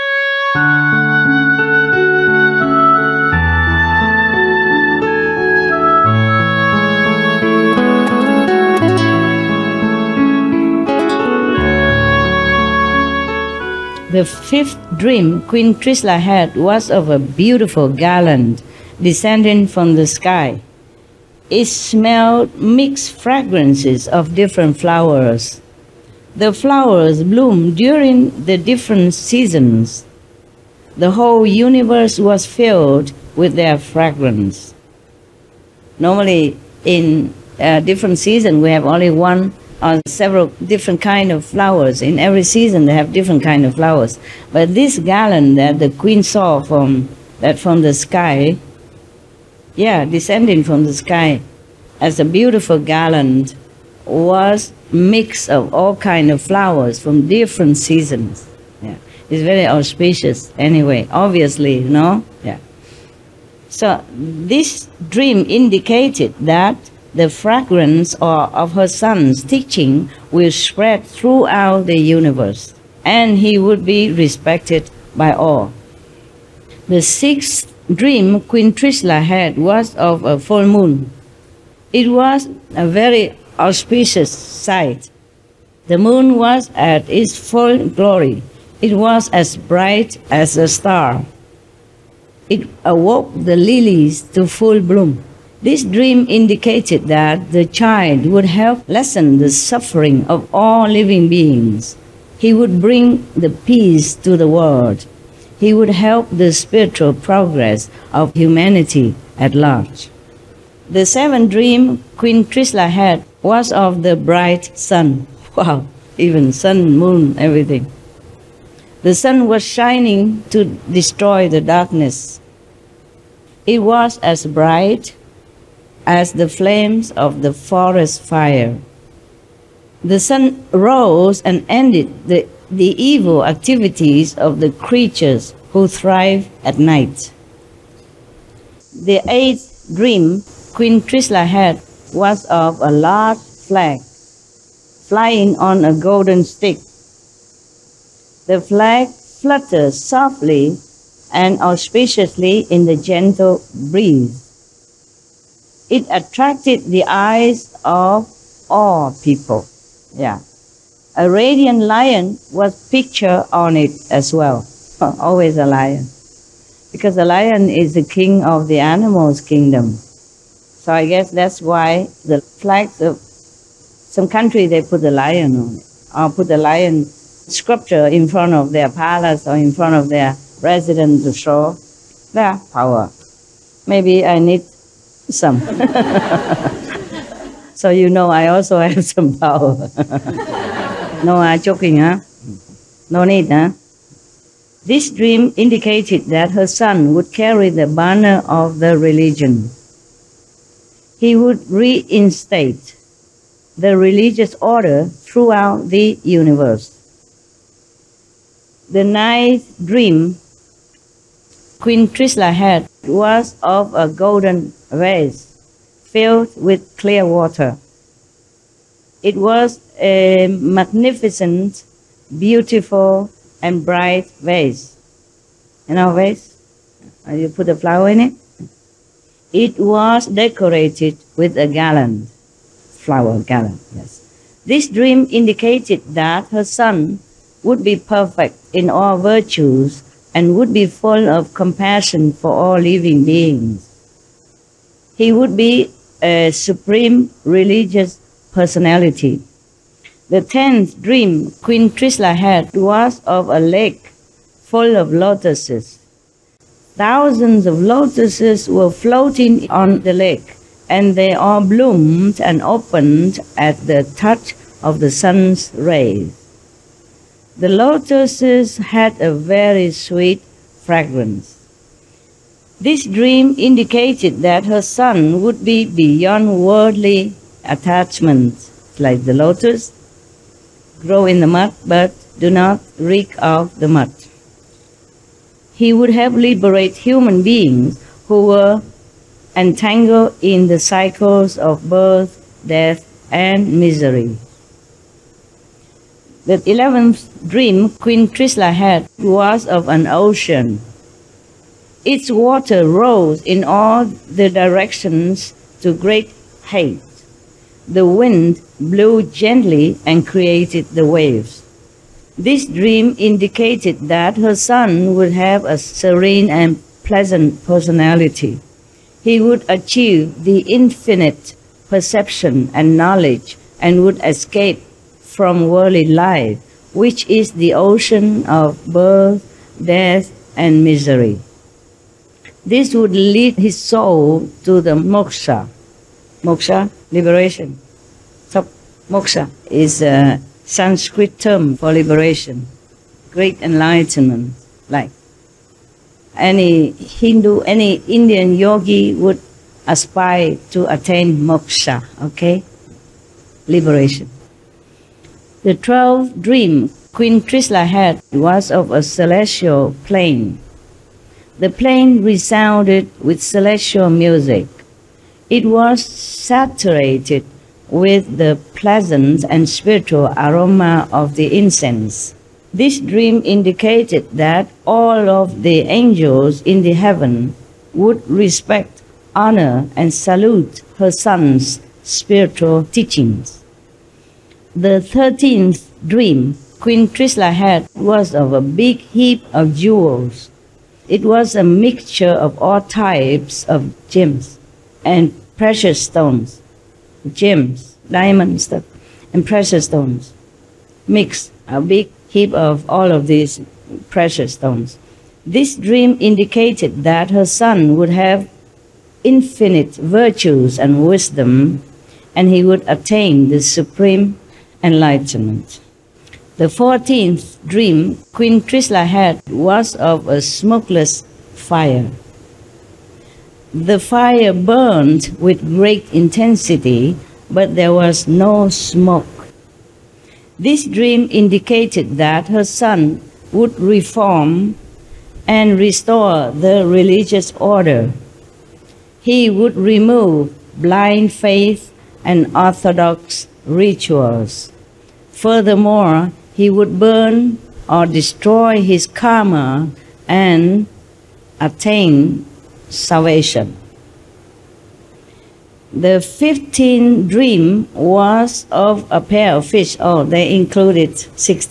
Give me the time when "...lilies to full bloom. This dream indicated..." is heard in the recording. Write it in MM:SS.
01:33.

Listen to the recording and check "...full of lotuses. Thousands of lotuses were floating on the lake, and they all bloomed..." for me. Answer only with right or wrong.
right.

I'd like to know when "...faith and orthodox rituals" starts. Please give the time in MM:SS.
07:21.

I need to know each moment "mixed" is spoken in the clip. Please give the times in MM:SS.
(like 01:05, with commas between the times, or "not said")
00:22, 06:41.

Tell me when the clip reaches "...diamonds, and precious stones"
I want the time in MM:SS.
06:38.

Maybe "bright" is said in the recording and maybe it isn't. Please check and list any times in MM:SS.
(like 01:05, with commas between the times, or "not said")
01:29, 01:54, 02:04, 03:43.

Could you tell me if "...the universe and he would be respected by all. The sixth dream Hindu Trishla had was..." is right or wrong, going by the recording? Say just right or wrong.
wrong.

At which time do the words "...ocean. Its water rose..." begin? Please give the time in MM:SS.
05:00.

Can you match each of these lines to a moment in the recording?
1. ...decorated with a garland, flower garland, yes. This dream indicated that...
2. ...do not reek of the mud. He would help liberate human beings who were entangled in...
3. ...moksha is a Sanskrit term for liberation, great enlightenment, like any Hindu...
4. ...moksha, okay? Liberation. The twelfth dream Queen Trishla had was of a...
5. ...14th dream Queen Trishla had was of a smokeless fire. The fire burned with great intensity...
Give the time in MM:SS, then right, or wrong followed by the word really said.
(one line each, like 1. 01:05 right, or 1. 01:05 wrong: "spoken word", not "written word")
1. 03:50 right
2. 04:42 right
3. 05:39 right
4. 05:51 right
5. 06:56 right.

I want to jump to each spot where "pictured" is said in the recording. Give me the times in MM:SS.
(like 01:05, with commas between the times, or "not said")
02:42.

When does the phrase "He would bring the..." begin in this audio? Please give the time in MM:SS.
01:42.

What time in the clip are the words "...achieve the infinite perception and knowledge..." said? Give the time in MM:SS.
05:19.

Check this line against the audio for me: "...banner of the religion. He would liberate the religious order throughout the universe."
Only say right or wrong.
wrong.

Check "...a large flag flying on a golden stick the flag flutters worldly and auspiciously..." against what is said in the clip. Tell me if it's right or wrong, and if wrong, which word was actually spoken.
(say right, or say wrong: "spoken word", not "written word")
wrong: "softly", not "worldly".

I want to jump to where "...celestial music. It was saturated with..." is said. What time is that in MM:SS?
06:03.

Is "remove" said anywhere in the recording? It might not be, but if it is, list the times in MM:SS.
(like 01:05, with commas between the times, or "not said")
07:19.